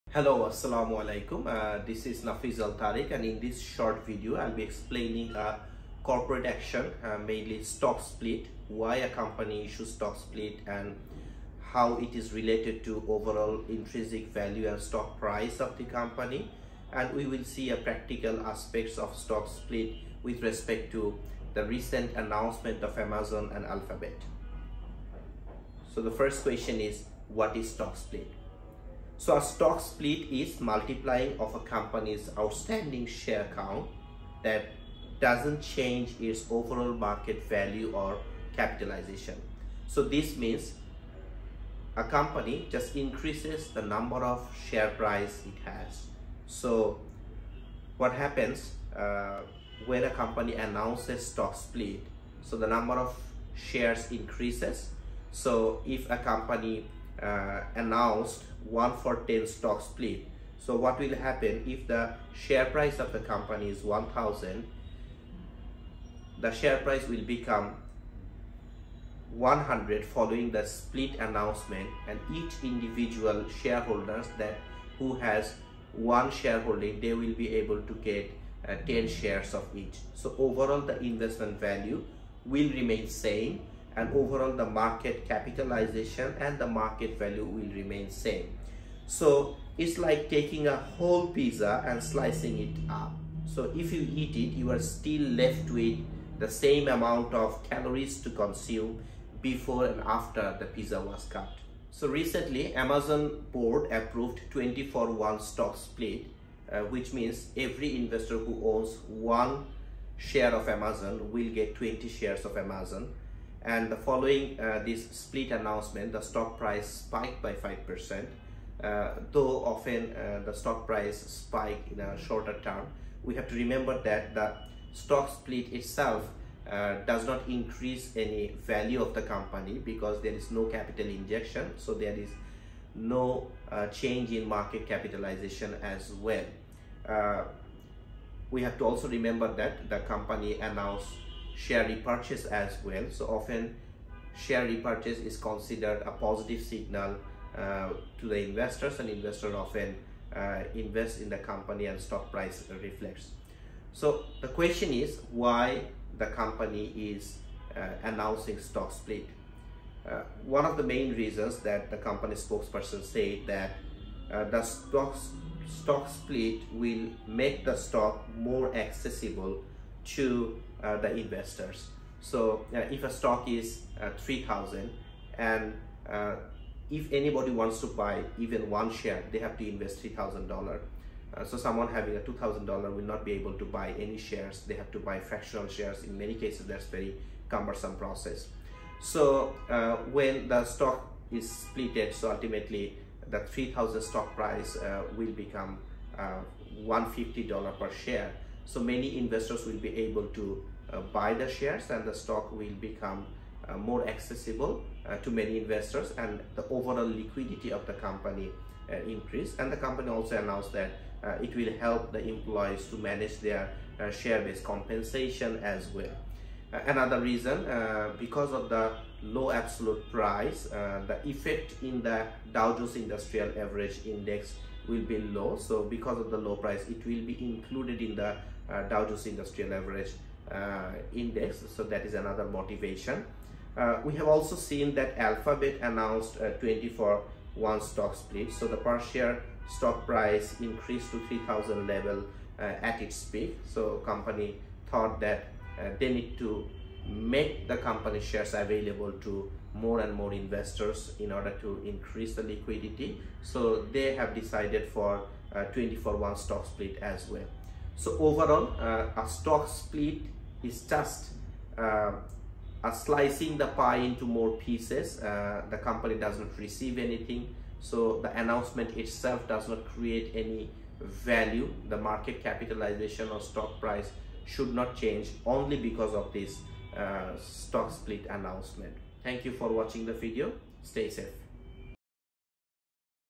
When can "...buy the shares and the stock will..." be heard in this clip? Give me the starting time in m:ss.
3:21.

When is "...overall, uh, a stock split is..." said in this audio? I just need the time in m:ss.
4:18.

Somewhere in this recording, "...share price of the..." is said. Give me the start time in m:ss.
1:02.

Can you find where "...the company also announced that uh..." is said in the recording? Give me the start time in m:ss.
3:29.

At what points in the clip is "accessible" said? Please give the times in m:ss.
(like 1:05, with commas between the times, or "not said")
2:48, 3:24.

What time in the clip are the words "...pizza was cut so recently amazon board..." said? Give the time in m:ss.
1:40.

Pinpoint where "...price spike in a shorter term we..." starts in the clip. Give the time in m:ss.
2:00.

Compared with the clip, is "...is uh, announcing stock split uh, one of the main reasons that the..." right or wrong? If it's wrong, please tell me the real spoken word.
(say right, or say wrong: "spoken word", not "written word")
right.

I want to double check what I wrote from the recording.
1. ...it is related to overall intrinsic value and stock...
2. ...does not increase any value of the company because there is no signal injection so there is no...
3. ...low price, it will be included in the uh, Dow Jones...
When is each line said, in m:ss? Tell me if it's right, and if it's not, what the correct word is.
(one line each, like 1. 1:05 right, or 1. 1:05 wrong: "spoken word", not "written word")
1. 0:11 right
2. 2:07 wrong: "capital", not "signal"
3. 3:46 right.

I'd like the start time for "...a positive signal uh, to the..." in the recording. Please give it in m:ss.
2:26.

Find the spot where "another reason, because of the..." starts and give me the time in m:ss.
3:36.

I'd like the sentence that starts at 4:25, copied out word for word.
Uh, the company does not receive anything.